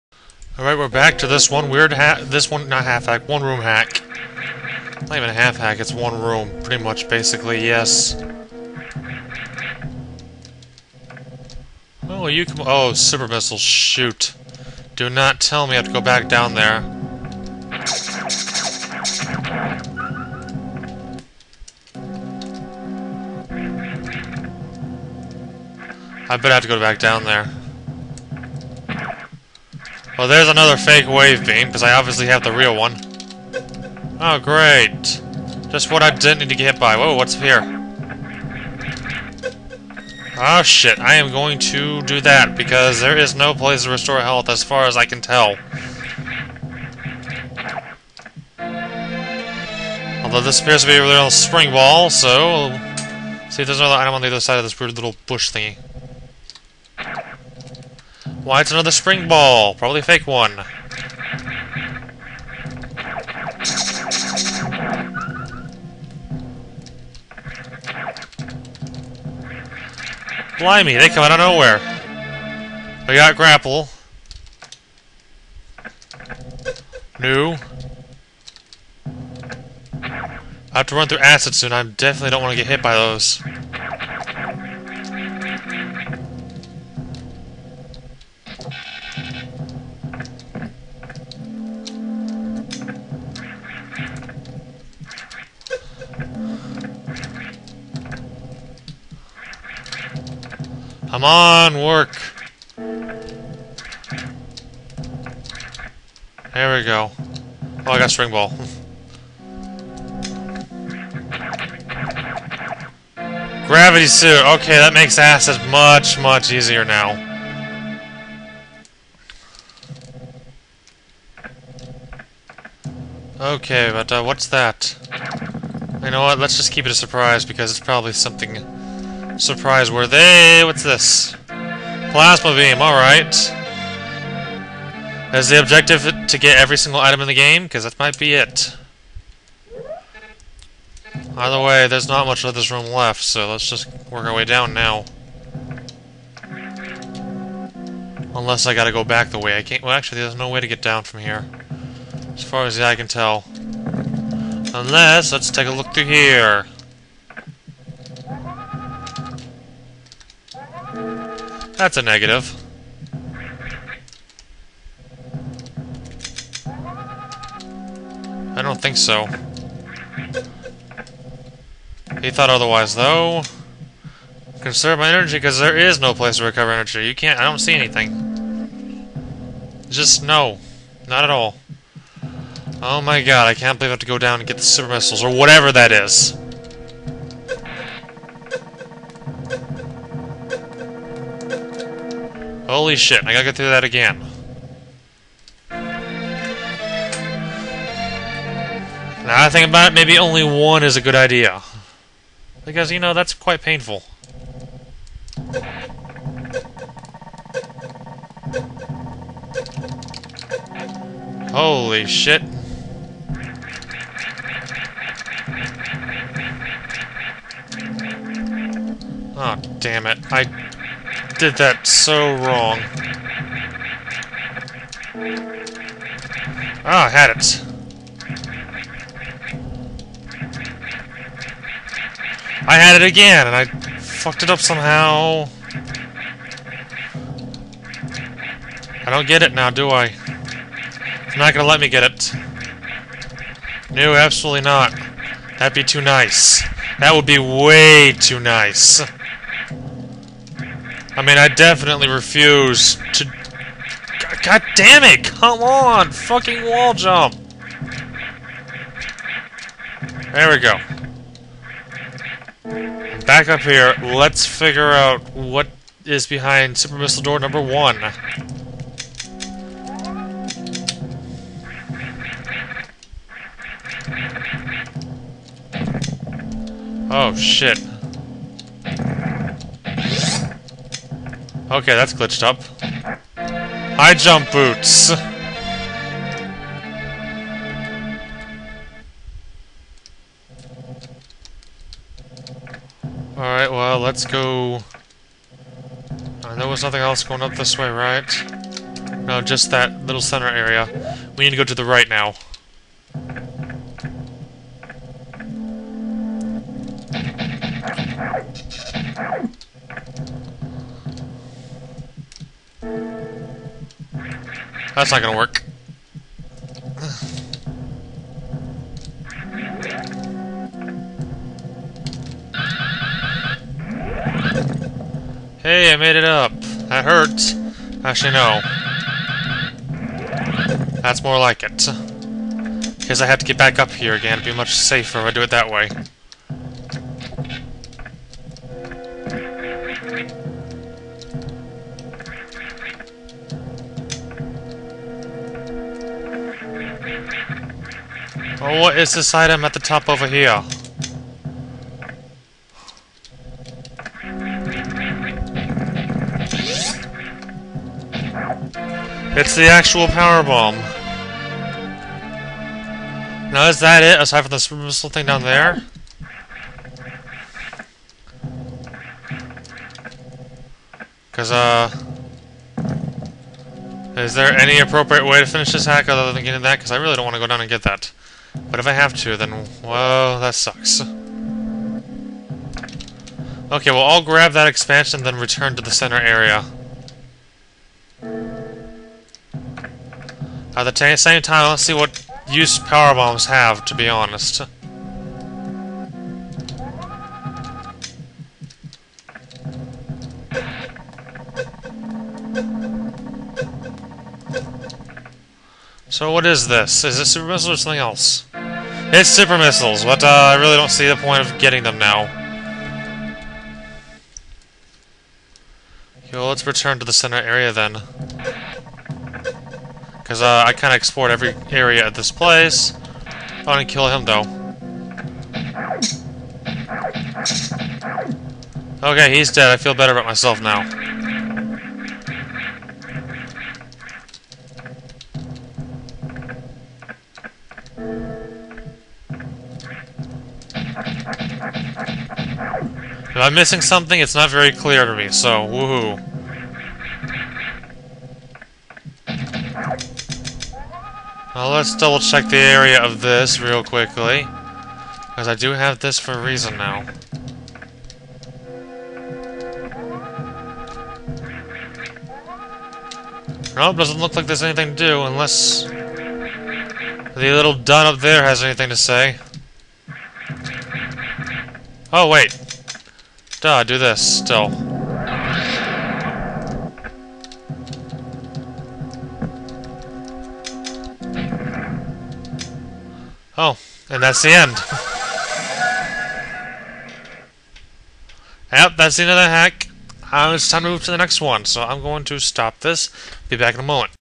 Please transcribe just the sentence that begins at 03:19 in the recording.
Now I think about it, maybe only one is a good idea.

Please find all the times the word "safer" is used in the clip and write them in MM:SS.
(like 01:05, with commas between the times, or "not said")
05:34.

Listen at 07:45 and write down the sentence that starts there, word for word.
The little dun up there has anything to say.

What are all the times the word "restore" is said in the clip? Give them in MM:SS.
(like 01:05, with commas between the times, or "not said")
00:43.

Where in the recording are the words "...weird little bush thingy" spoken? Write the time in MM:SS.
00:54.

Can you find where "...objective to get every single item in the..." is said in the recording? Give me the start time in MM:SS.
02:15.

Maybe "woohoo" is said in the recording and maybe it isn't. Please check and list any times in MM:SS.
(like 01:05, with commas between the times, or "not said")
07:25.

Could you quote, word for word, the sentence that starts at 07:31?
Well, let's double check the area of this real quickly.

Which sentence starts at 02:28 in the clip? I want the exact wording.
Unless I gotta go back the way I came.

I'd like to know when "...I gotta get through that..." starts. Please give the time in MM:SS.
03:13.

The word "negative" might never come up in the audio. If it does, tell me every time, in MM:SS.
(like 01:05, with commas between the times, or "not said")
02:42.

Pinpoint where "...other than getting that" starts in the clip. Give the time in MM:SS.
06:16.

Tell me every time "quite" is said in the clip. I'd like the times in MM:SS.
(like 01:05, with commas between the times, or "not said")
03:23.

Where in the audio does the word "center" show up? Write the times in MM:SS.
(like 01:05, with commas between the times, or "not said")
05:00, 06:25, 06:57.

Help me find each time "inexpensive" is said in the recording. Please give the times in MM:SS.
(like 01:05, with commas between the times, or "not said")
not said.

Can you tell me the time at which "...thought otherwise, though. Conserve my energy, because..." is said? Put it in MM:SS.
02:52.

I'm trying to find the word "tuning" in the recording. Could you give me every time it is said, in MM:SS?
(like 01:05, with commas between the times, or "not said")
not said.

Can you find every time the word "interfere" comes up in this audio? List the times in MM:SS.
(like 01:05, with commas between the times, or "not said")
not said.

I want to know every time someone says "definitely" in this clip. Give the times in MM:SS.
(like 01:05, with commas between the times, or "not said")
01:21, 04:11.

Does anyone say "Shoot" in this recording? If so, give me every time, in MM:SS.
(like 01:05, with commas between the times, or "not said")
00:13.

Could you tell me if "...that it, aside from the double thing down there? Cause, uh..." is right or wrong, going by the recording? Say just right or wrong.
wrong.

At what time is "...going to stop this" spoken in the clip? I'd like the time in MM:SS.
08:12.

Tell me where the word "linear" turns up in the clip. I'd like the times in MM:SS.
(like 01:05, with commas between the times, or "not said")
not said.